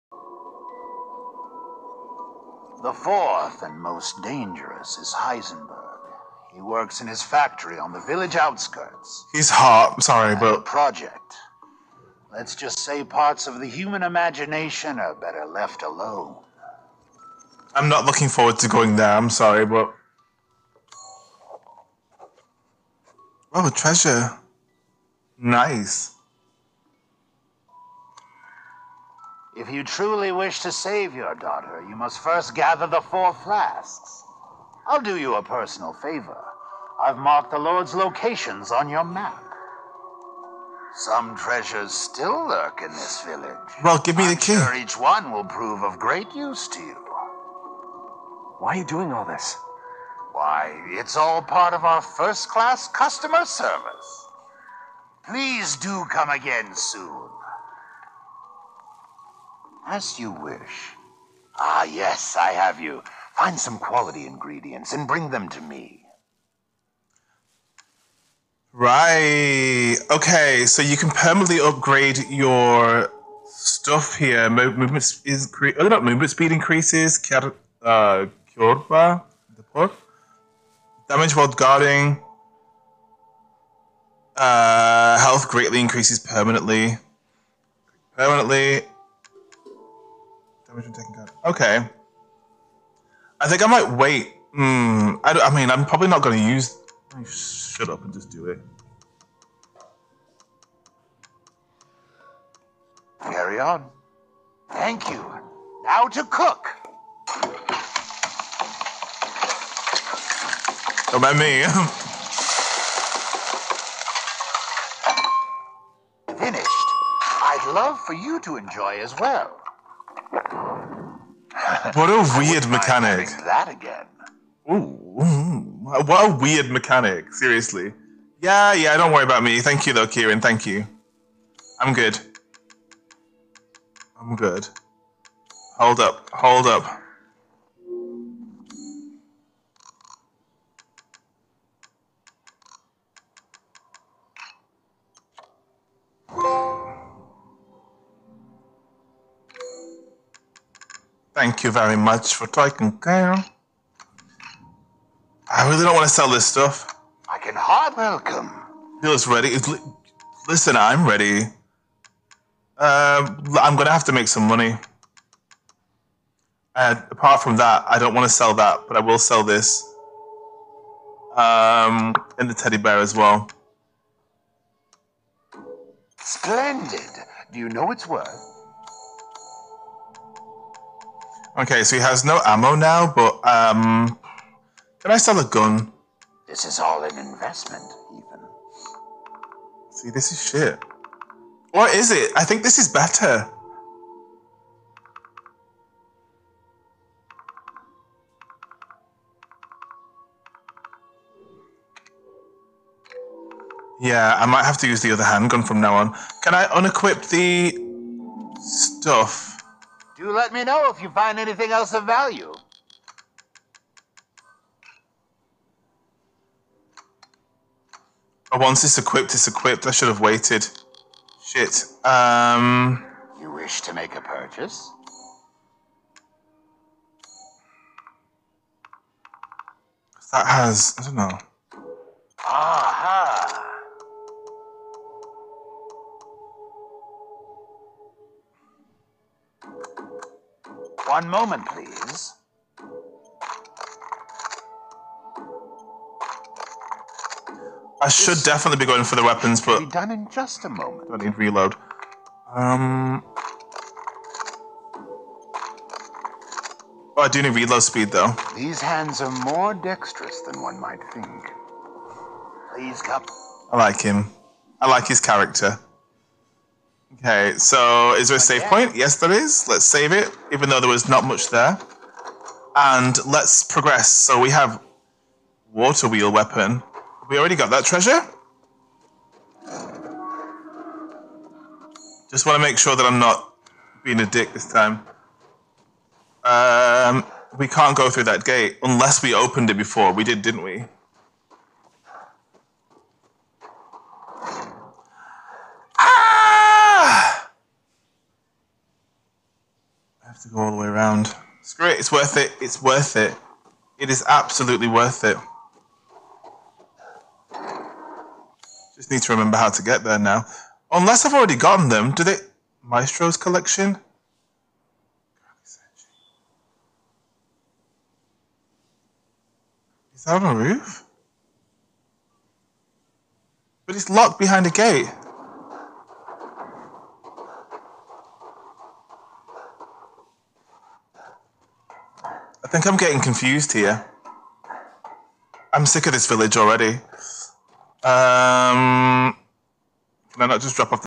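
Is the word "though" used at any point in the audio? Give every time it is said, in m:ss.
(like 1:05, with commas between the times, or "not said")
2:09, 4:18, 4:30.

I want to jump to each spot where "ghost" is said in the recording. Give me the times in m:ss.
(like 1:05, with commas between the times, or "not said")
not said.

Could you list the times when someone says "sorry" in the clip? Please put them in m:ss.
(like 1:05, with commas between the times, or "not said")
0:10, 0:19.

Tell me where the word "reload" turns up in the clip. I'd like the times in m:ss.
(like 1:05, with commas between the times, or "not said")
4:11, 4:17.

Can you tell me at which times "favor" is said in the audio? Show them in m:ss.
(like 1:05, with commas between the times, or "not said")
0:35.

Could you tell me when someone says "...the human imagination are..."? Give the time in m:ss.
0:13.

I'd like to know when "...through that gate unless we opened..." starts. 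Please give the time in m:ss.
4:48.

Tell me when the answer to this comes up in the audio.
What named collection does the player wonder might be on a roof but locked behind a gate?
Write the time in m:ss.
5:12.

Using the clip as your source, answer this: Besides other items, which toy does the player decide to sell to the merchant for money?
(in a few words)
Teddy bear.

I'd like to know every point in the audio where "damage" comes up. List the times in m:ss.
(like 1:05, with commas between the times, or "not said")
1:21, 1:30.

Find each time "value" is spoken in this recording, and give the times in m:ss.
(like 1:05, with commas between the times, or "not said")
3:32.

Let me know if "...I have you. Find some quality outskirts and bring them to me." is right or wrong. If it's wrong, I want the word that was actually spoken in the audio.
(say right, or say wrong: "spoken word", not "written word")
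wrong: "ingredients", not "outskirts".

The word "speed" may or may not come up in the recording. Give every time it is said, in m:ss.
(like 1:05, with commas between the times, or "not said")
1:16, 4:17.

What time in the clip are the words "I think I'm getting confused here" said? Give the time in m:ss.
5:32.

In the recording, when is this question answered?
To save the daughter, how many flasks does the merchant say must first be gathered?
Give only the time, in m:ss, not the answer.
0:33.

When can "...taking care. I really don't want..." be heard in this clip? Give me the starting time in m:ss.
2:32.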